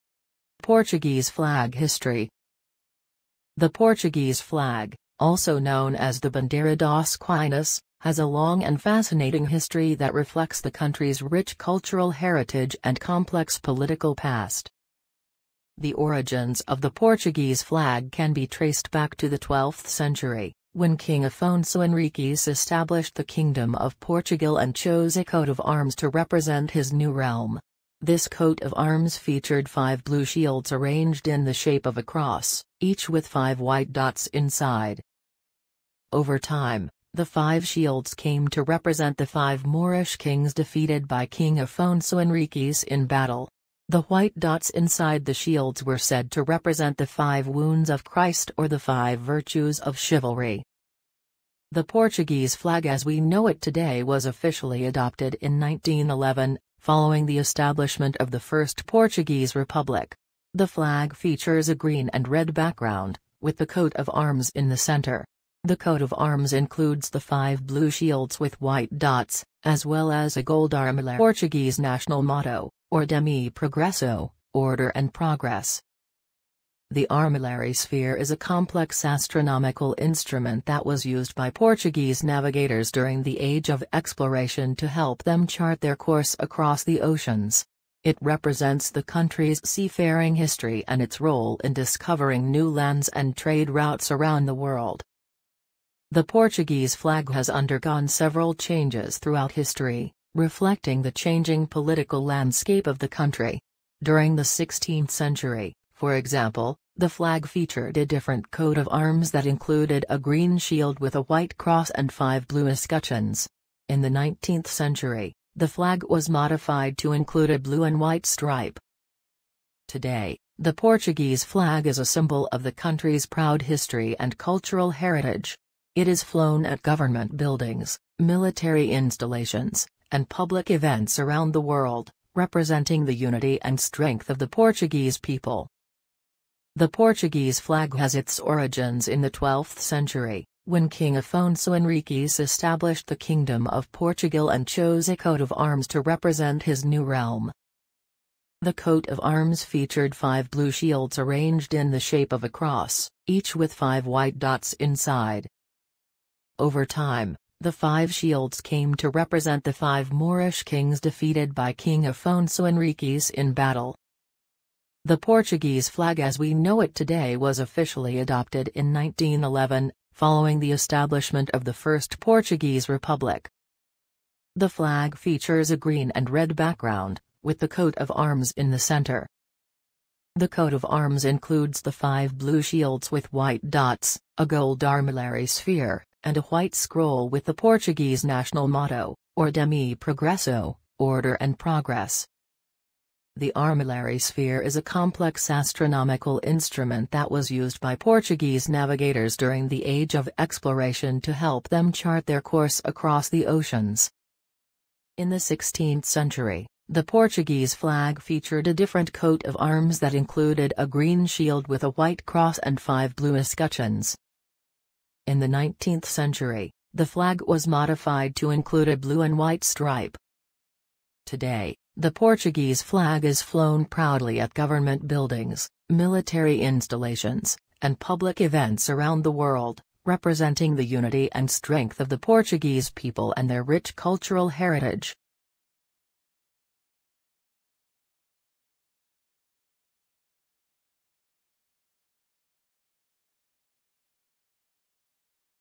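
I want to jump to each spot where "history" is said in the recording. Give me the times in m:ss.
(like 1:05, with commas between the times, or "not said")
0:01, 0:09, 1:30, 1:39, 2:03.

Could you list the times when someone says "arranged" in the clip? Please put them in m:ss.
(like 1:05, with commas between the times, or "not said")
0:30, 2:31.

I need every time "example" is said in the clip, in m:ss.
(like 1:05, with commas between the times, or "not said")
1:46.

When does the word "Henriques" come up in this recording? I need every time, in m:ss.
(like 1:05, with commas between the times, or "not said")
0:21, 0:42, 2:21, 2:42.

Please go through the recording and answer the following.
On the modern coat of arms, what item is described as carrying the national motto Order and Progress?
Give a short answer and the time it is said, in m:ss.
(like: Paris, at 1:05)
A white scroll, at 3:06.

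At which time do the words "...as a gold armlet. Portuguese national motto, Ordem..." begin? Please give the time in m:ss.
1:10.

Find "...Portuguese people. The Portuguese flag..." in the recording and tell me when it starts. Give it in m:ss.
2:14.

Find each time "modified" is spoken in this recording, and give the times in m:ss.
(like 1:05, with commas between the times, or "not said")
1:56, 3:37.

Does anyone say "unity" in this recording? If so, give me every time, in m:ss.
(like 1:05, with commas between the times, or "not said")
2:13, 3:50.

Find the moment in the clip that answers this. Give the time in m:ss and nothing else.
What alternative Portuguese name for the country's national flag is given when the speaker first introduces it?
0:06.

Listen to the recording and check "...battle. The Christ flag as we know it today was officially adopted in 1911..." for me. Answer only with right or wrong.
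wrong.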